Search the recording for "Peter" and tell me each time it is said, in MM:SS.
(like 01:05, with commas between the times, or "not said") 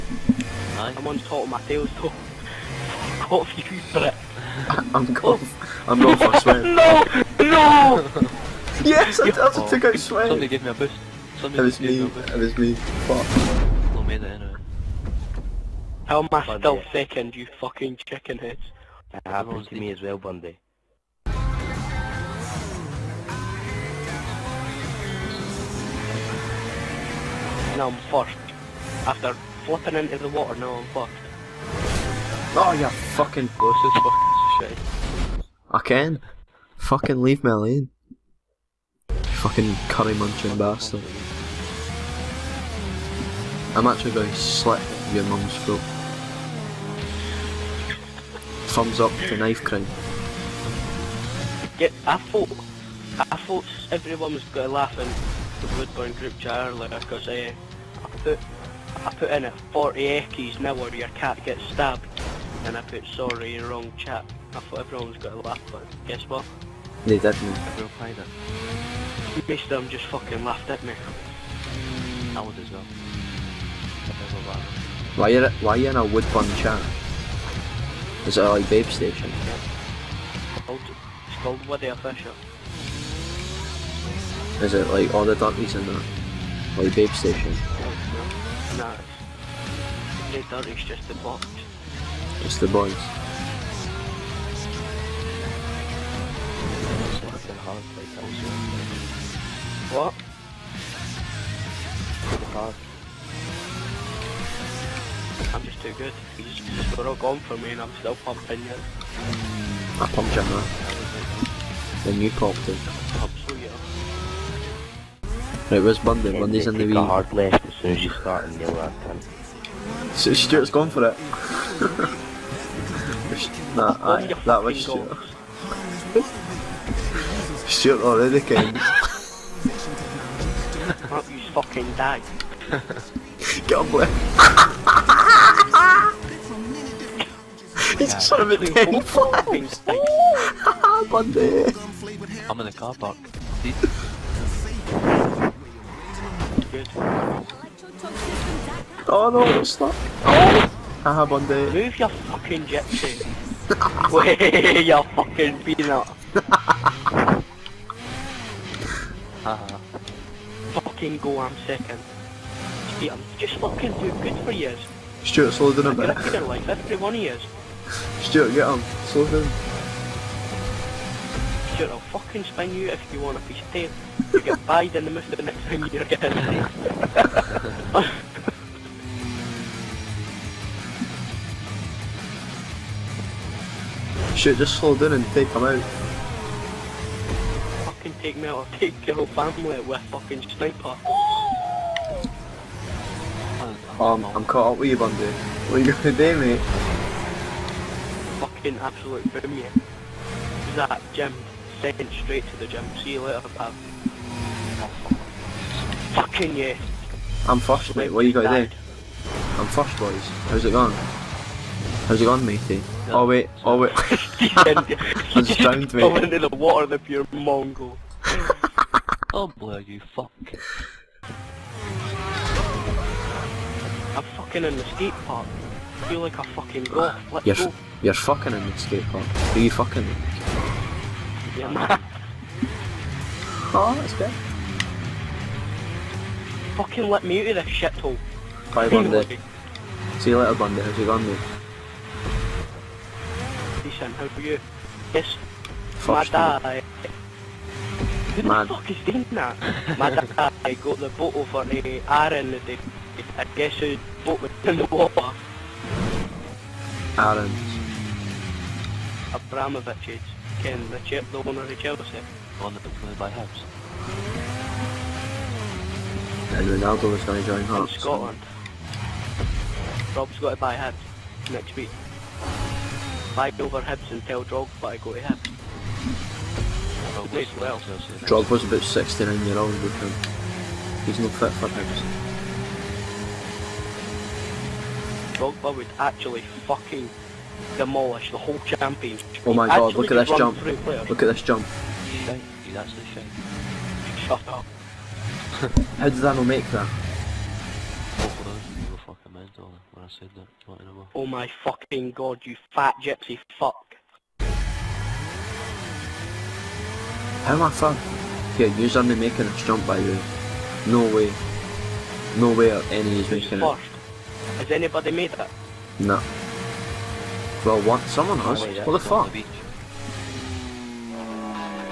not said.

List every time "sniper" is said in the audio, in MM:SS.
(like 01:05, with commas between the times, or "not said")
03:10.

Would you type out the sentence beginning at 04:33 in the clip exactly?
Buy over Hibs and tell Drogba to go to Hibs.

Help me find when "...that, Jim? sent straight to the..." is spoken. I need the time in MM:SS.
03:20.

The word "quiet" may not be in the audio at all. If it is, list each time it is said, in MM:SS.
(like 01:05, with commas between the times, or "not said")
not said.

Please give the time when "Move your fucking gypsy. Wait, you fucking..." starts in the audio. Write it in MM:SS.
02:31.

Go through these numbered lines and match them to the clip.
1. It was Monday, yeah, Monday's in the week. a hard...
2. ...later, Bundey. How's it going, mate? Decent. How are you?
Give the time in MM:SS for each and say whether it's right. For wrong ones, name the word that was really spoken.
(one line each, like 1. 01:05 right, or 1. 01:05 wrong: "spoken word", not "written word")
1. 01:55 right
2. 04:00 right.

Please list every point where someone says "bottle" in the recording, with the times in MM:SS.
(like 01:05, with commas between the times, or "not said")
04:11.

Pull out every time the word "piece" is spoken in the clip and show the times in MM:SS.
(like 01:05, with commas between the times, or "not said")
02:53.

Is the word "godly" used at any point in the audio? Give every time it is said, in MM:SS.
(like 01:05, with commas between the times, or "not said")
not said.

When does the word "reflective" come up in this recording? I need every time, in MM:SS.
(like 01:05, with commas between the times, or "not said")
not said.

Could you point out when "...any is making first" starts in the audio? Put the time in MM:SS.
05:12.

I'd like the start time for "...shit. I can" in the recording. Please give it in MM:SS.
00:34.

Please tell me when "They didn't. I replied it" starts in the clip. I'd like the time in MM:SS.
01:07.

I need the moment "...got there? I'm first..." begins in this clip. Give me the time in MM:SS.
03:28.